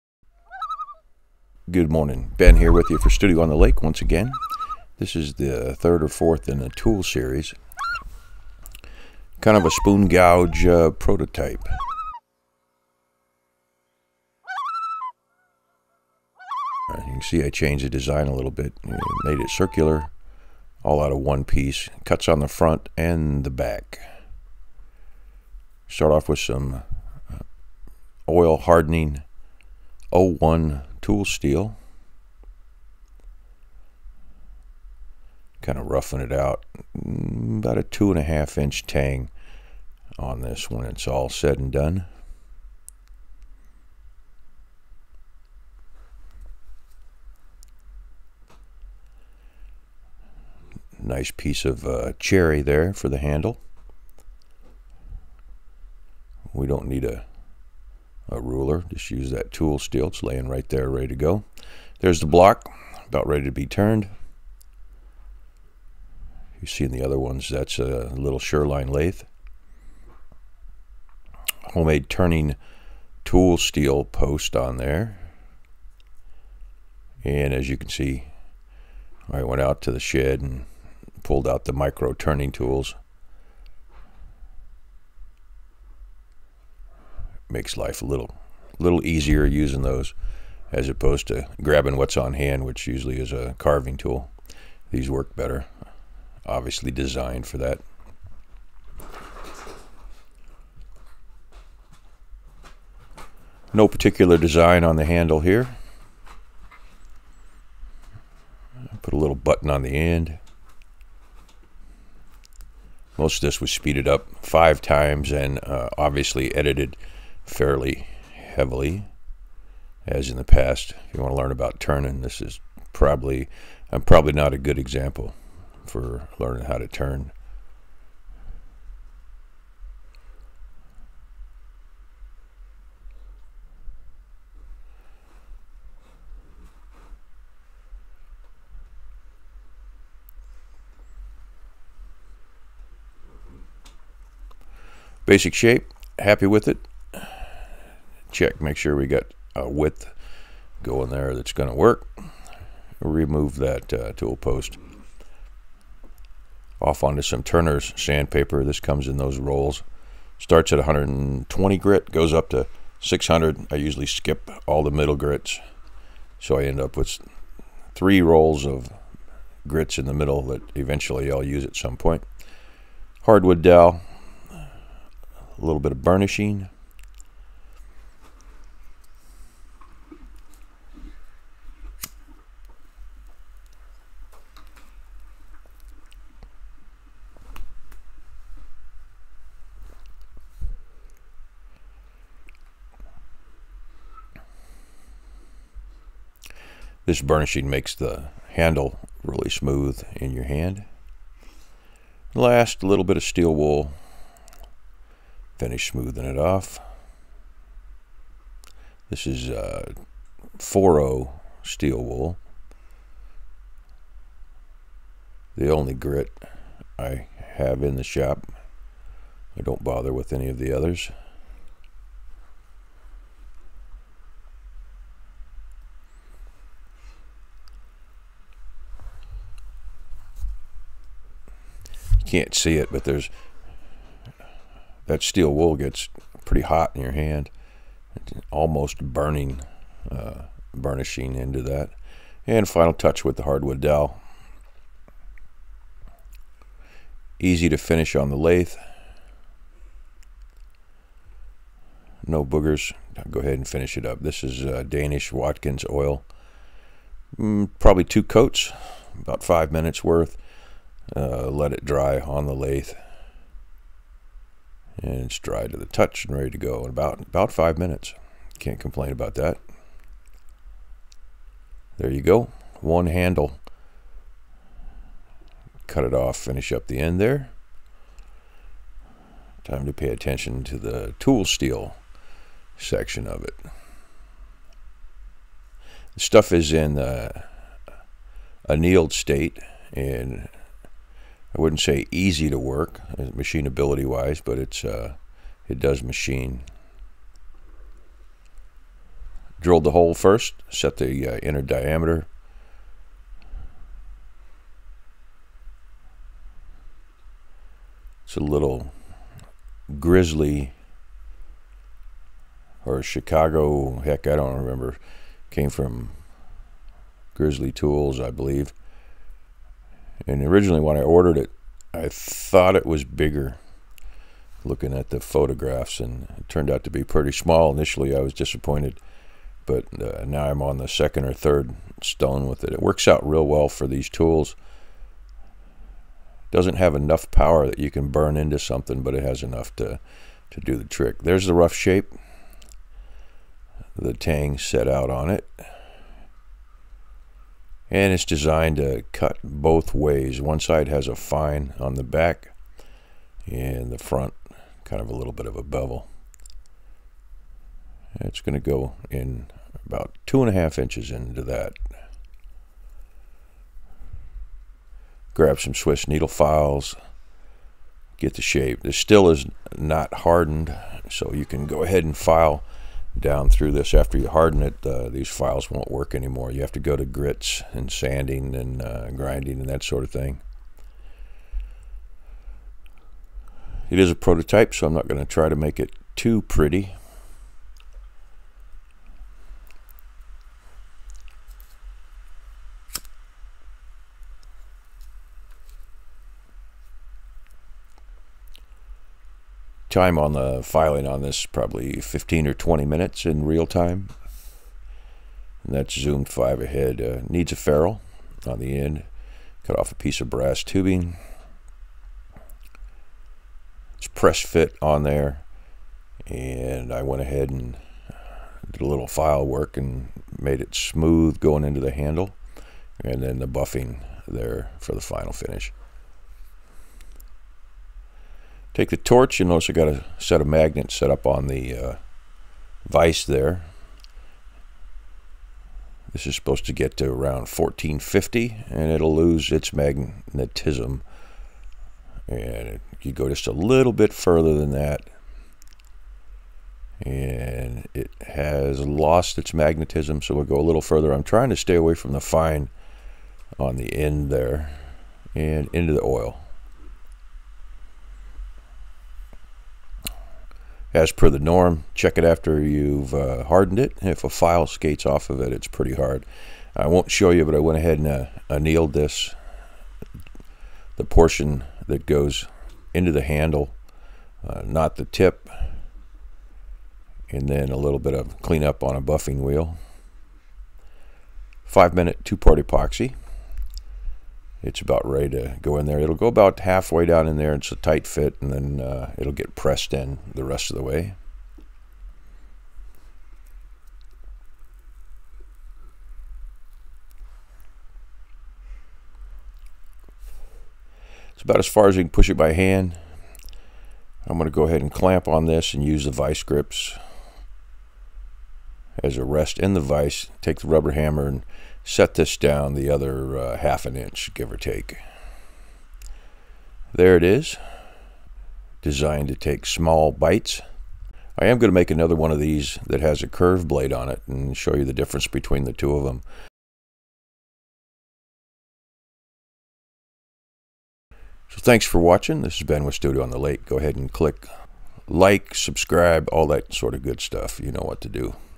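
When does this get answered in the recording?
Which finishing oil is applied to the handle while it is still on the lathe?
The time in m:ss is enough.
4:14.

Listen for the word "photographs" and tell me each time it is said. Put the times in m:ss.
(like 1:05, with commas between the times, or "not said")
5:25.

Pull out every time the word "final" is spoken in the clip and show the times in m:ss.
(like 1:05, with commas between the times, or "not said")
4:02, 7:05.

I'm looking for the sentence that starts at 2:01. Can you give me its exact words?
If you want to learn about turning, this is probably, I'm probably not a good example for learning how to turn.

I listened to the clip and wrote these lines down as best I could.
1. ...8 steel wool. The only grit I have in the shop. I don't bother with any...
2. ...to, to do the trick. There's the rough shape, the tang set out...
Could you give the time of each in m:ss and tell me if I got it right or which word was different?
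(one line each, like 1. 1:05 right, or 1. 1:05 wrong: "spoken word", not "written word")
1. 3:30 wrong: "4", not "8"
2. 5:39 right.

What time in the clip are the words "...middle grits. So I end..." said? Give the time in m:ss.
2:44.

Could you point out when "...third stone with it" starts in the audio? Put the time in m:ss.
5:31.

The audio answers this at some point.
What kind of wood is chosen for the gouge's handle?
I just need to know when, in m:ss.
0:52.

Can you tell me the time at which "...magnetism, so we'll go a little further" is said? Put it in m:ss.
7:29.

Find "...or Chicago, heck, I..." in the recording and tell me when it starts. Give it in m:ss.
5:12.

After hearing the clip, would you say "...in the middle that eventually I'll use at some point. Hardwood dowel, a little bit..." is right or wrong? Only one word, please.
right.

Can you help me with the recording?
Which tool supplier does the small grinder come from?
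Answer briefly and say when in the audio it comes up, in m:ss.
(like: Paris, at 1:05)
Grizzly Tools, at 5:17.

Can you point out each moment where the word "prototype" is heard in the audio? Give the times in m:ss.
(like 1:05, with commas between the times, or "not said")
0:10, 6:24.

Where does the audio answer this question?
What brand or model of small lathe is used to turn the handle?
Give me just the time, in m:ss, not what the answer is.
1:08.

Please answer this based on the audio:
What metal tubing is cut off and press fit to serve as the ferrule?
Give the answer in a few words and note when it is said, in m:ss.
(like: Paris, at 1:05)
Brass, at 6:50.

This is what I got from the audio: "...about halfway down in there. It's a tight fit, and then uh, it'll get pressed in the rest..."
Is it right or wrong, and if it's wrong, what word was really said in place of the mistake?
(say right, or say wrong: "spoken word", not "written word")
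right.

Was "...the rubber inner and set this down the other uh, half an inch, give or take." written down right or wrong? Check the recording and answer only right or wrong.
wrong.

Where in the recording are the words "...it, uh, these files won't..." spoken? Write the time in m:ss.
6:14.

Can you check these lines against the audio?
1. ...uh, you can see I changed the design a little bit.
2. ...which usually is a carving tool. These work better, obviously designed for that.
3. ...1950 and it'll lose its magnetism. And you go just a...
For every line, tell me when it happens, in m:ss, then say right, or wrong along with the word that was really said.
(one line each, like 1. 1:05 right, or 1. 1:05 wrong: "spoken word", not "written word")
1. 0:16 right
2. 1:32 right
3. 7:17 wrong: "1450", not "1950".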